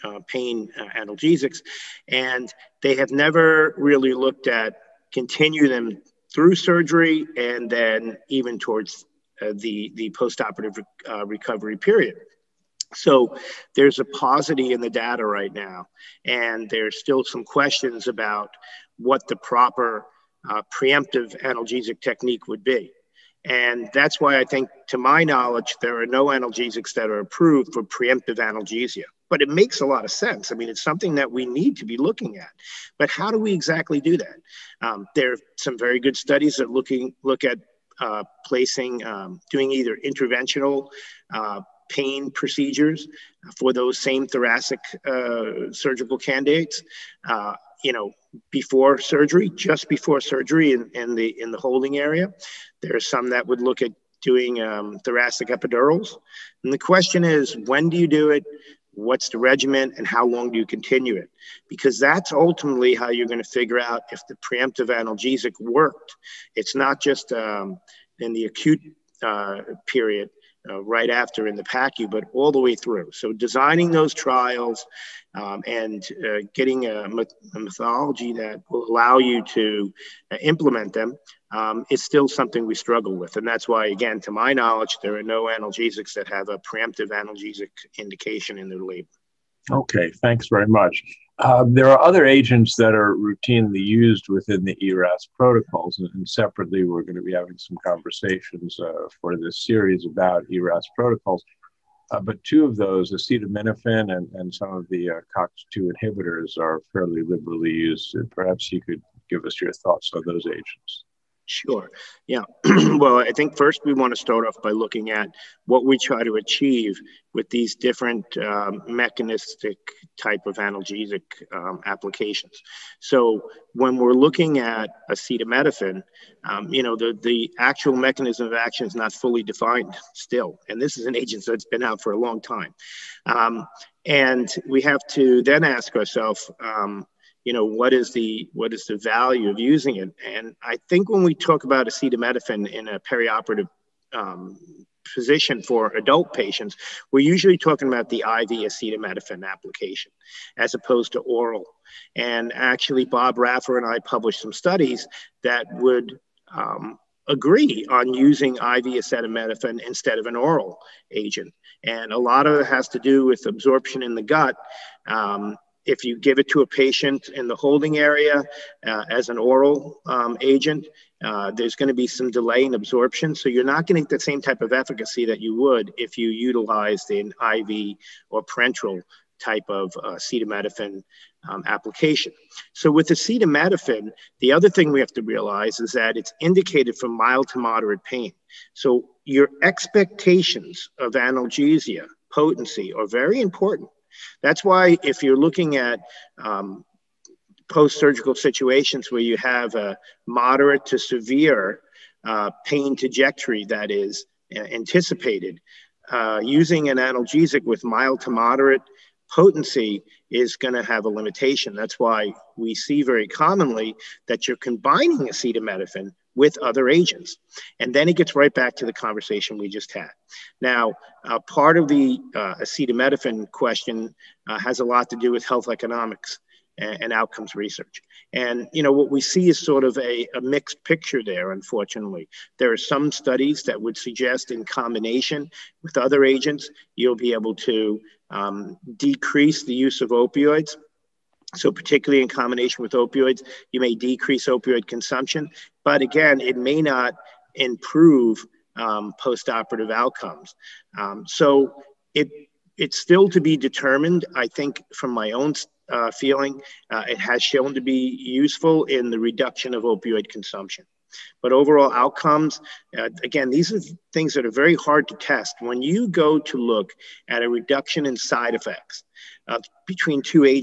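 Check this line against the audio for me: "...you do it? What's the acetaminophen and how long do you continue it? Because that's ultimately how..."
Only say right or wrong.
wrong.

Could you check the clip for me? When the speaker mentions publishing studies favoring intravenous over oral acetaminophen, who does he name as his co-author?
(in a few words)
Bob Raffa.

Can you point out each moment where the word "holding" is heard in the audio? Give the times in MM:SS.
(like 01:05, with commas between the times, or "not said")
00:51, 02:47.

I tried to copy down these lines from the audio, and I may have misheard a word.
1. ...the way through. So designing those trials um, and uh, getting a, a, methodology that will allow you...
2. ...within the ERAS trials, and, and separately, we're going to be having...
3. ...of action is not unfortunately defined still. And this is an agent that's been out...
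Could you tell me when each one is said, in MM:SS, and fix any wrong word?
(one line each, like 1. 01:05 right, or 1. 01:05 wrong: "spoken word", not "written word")
1. 01:12 right
2. 01:34 wrong: "protocols", not "trials"
3. 02:08 wrong: "fully", not "unfortunately".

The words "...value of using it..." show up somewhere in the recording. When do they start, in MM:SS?
02:18.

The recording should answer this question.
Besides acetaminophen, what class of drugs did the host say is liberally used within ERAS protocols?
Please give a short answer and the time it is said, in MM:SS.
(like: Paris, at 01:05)
COX2 inhibitors, at 01:45.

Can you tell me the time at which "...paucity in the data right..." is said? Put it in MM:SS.
00:14.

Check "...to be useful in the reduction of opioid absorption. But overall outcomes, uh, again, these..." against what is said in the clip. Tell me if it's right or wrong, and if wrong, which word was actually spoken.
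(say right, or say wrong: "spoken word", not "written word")
wrong: "consumption", not "absorption".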